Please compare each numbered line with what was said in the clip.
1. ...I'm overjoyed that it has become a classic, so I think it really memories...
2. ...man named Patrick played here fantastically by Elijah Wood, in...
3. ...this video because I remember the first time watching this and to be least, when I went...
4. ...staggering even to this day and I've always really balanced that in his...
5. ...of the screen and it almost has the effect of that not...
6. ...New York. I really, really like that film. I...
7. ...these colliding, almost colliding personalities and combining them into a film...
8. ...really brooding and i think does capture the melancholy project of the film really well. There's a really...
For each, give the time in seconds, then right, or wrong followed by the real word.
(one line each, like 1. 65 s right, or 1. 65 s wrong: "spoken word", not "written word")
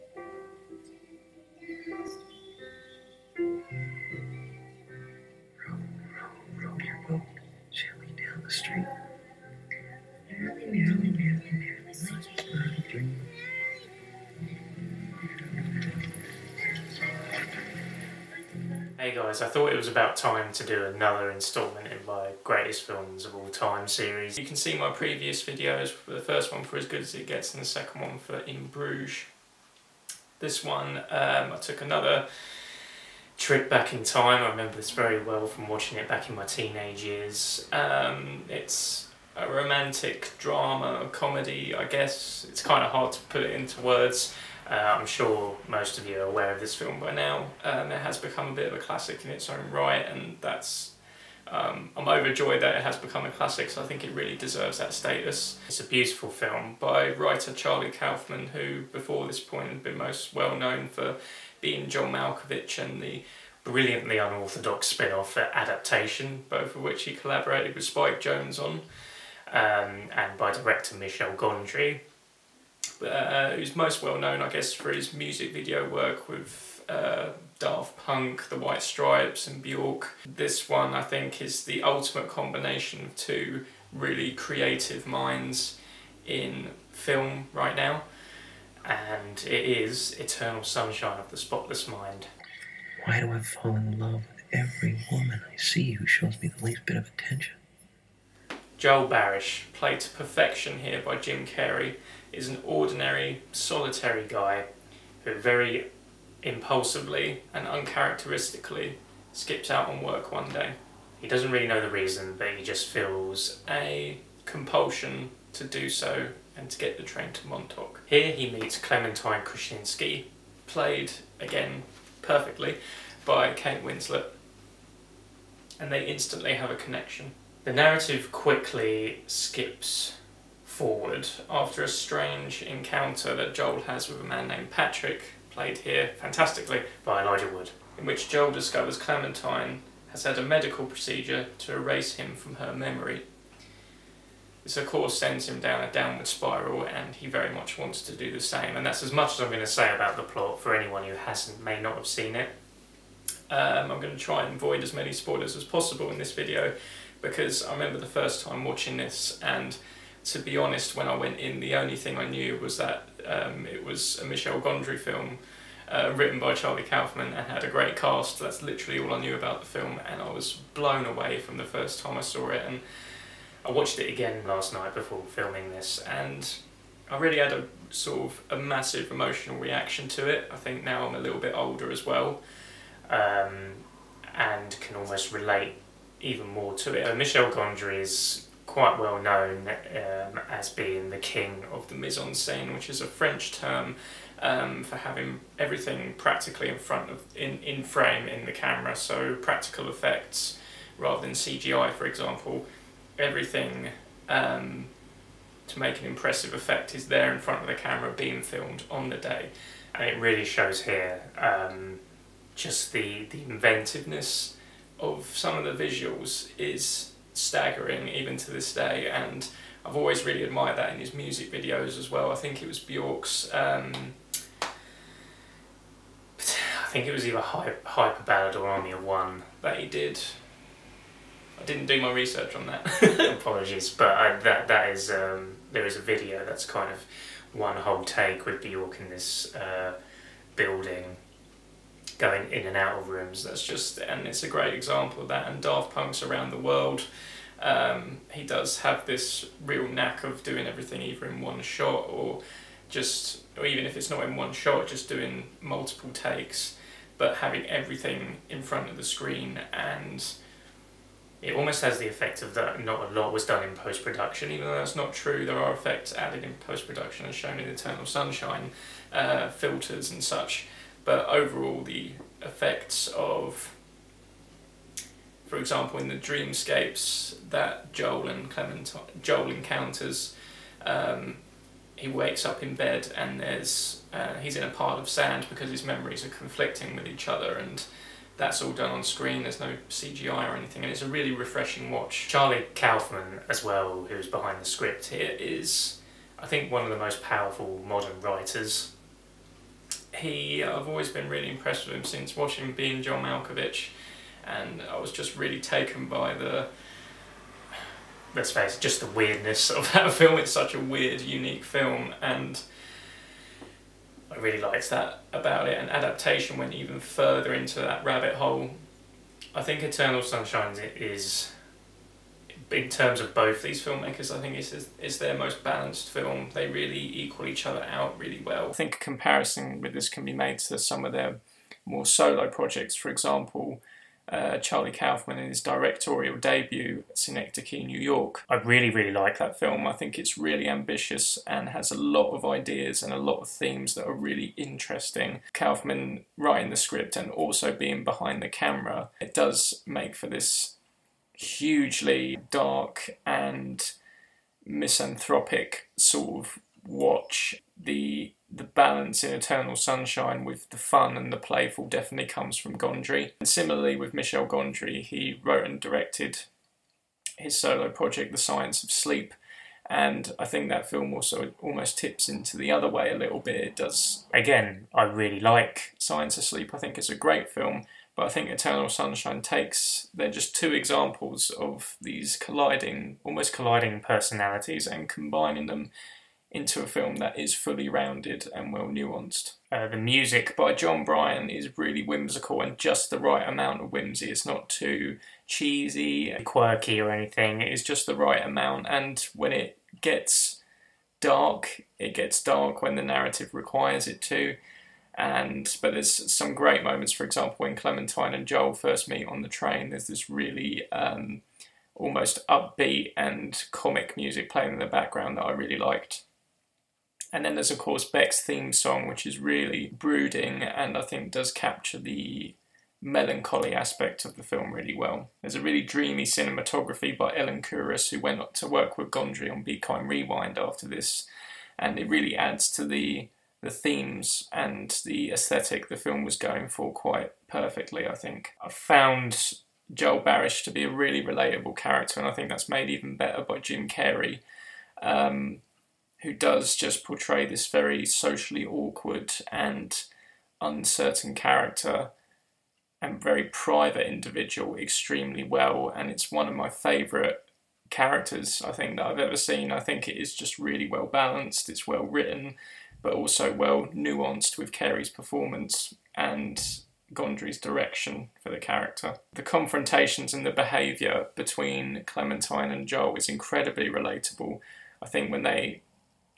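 1. 51 s wrong: "deserves", not "memories"
2. 134 s right
3. 156 s wrong: "honest", not "least"
4. 217 s wrong: "admired", not "balanced"
5. 258 s right
6. 337 s right
7. 381 s right
8. 419 s wrong: "aspect", not "project".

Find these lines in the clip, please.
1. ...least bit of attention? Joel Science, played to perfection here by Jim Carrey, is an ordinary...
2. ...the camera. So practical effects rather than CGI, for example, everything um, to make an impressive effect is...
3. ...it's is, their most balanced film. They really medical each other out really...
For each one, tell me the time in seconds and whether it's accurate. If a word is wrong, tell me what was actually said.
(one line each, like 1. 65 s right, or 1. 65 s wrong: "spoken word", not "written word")
1. 96 s wrong: "Barish", not "Science"
2. 198 s right
3. 324 s wrong: "equal", not "medical".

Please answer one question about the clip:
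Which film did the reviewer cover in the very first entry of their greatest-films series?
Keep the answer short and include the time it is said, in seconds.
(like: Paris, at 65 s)
As Good As It Gets, at 26 s.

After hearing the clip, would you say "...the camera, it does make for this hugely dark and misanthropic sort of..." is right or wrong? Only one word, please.
right.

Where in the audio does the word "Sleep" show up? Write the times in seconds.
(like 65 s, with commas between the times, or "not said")
368 s, 376 s.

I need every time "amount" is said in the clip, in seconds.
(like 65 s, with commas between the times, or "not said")
393 s, 398 s.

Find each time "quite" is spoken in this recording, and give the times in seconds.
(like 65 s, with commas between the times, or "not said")
188 s, 436 s.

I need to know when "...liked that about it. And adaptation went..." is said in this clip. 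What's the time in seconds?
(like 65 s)
314 s.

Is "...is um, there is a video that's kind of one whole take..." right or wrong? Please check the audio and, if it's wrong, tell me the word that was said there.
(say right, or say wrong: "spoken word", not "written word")
right.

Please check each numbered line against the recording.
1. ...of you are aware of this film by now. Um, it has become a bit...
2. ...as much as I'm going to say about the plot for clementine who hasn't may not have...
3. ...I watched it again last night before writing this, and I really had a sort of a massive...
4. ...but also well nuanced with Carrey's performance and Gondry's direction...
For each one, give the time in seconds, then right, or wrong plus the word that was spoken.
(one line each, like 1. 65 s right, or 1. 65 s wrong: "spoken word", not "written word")
1. 45 s right
2. 149 s wrong: "anyone", not "clementine"
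3. 173 s wrong: "filming", not "writing"
4. 463 s right.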